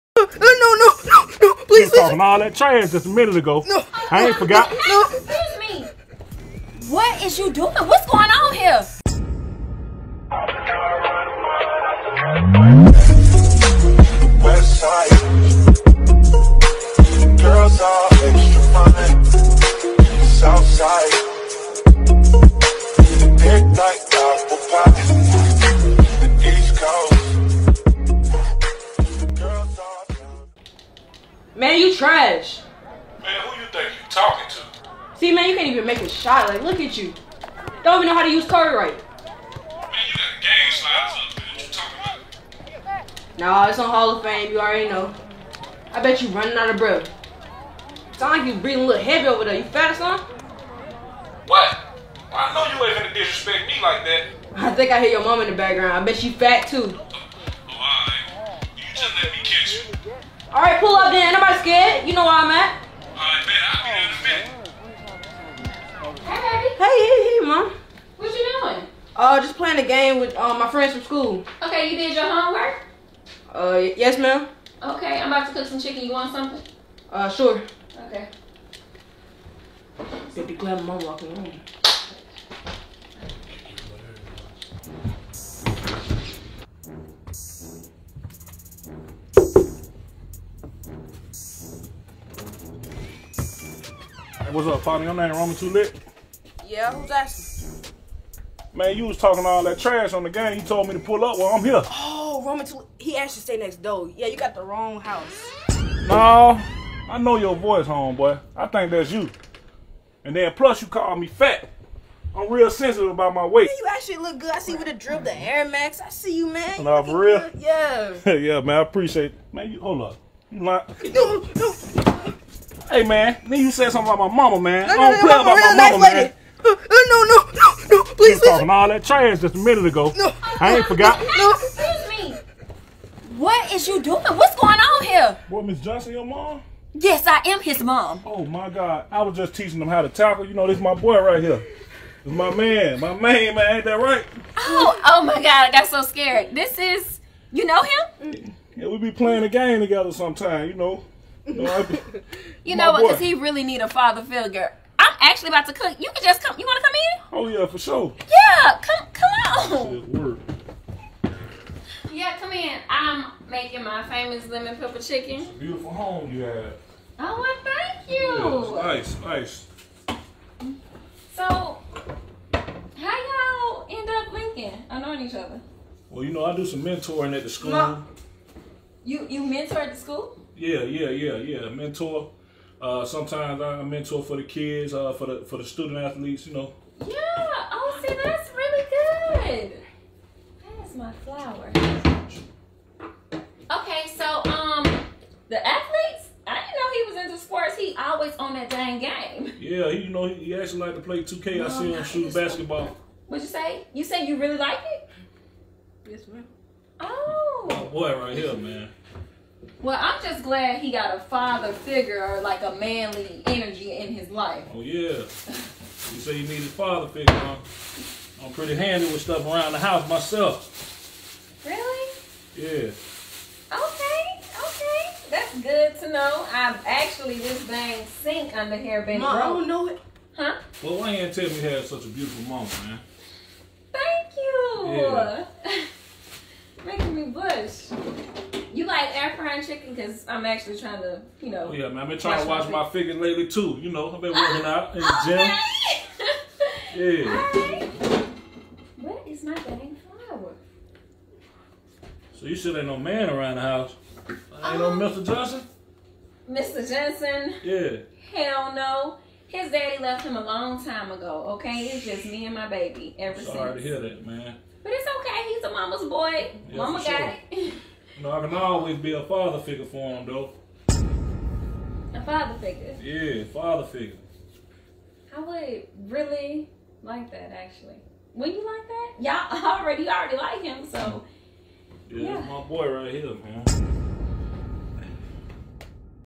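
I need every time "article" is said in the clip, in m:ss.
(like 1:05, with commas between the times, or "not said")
not said.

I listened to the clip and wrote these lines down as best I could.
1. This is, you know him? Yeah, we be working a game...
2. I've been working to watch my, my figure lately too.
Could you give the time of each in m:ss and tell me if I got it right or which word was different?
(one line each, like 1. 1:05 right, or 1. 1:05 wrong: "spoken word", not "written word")
1. 2:26 wrong: "playing", not "working"
2. 4:02 wrong: "trying", not "working".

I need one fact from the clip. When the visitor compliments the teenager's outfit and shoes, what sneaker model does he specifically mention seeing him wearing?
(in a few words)
Air Max.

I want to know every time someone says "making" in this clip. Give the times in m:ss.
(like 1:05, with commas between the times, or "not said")
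2:43, 3:56.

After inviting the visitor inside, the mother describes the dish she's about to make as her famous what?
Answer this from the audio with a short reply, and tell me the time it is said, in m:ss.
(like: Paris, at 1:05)
Lemon pepper chicken, at 2:44.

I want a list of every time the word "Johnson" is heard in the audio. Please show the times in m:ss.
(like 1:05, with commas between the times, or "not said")
2:15, 4:15.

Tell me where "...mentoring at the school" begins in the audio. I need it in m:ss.
2:56.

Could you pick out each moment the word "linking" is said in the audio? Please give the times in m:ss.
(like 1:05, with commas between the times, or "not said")
2:54.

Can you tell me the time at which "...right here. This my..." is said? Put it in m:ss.
2:21.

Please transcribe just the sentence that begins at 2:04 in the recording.
No, no, I don't no, play no, about my mama, nice man.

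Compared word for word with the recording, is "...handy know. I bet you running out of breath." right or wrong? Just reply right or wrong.
wrong.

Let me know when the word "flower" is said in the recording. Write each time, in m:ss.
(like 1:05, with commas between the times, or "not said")
3:11, 4:10.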